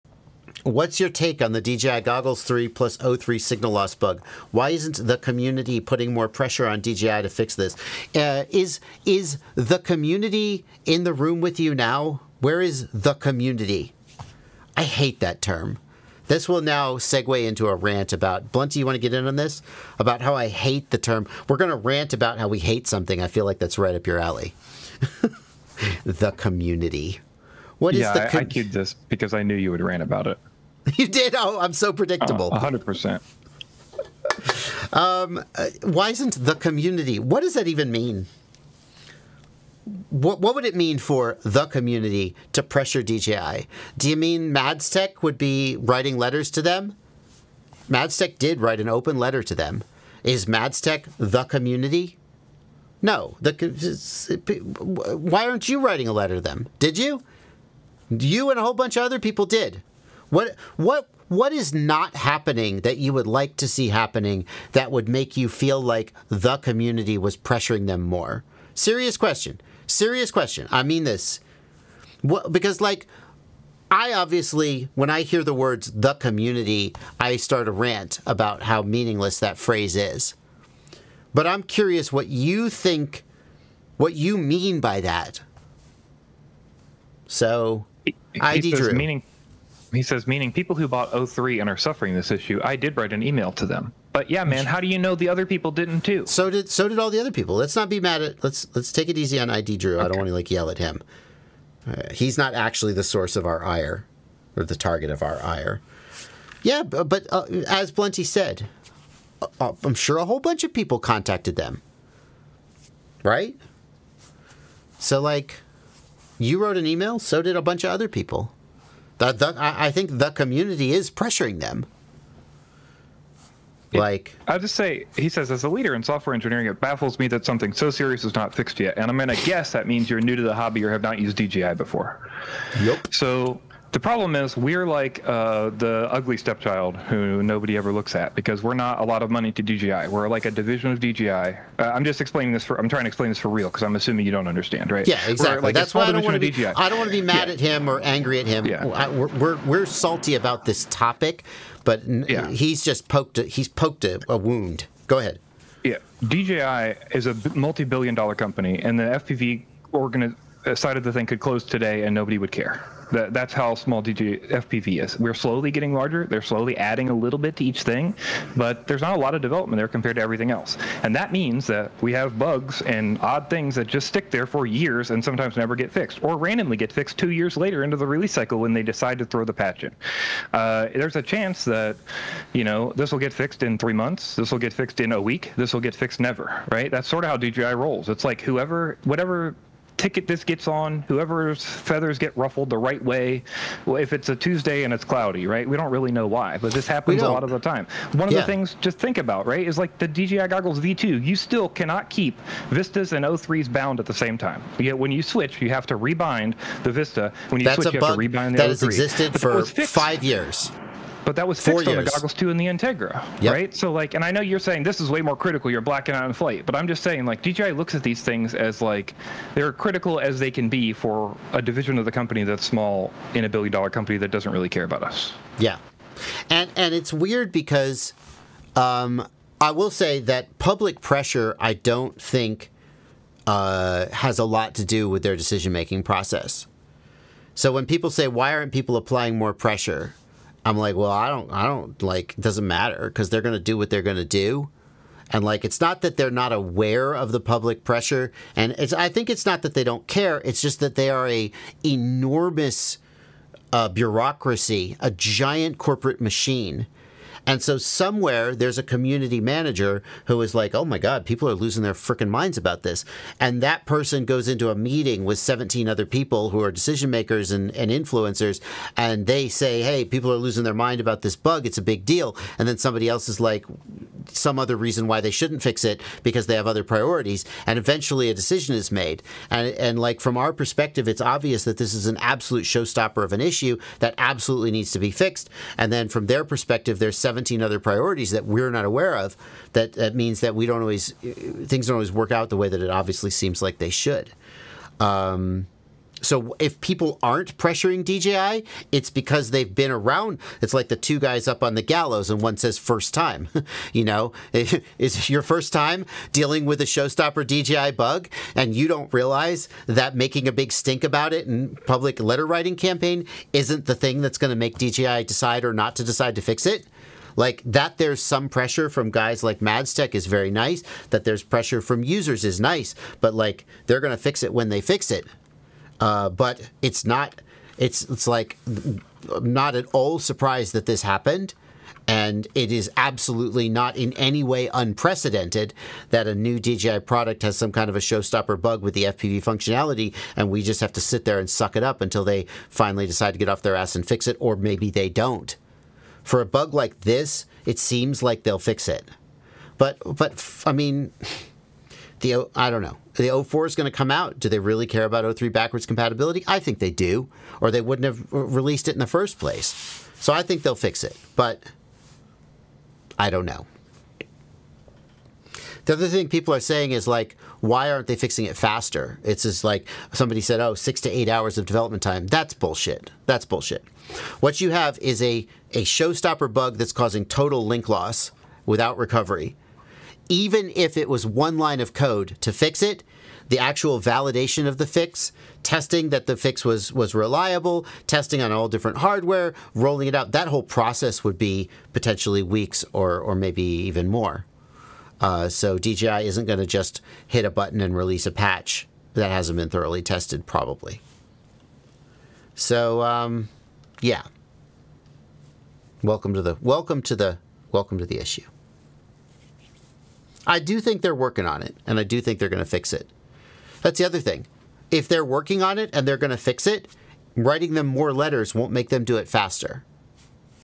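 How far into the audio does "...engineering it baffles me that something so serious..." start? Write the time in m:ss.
2:06.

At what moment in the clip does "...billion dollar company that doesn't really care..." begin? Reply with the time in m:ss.
3:43.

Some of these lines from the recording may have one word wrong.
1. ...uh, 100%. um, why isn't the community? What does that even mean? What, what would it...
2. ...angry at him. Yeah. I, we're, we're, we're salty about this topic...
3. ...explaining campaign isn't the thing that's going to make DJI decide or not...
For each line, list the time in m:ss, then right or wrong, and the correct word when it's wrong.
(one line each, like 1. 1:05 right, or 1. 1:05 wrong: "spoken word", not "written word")
1. 0:32 right
2. 2:27 right
3. 5:12 wrong: "writing", not "explaining".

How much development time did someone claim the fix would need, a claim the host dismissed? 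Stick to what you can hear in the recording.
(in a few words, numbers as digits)
6 to 8 hours.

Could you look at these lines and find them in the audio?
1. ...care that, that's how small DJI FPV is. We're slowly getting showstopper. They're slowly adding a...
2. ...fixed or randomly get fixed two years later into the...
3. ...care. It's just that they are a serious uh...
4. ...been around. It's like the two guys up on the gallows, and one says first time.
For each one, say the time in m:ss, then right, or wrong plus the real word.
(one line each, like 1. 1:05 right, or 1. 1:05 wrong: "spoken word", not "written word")
1. 2:42 wrong: "larger", not "showstopper"
2. 2:55 right
3. 4:10 wrong: "enormous", not "serious"
4. 4:59 right.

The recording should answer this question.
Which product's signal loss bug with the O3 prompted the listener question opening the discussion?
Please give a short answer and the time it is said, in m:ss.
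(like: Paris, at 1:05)
DJI Goggles 3, at 0:01.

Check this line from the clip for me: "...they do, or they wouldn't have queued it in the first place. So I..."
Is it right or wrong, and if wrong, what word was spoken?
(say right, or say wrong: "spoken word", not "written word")
wrong: "released", not "queued".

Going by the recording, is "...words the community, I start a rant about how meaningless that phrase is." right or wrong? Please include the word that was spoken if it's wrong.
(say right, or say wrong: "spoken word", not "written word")
right.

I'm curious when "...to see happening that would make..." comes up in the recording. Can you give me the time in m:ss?
1:03.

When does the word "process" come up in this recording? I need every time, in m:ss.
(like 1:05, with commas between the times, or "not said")
3:56, 6:30.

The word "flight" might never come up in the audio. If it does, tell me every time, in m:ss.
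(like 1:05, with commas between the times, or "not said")
3:36.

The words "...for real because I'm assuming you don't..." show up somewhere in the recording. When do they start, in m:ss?
2:23.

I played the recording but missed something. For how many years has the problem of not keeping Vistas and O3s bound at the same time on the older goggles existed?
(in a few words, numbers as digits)
5.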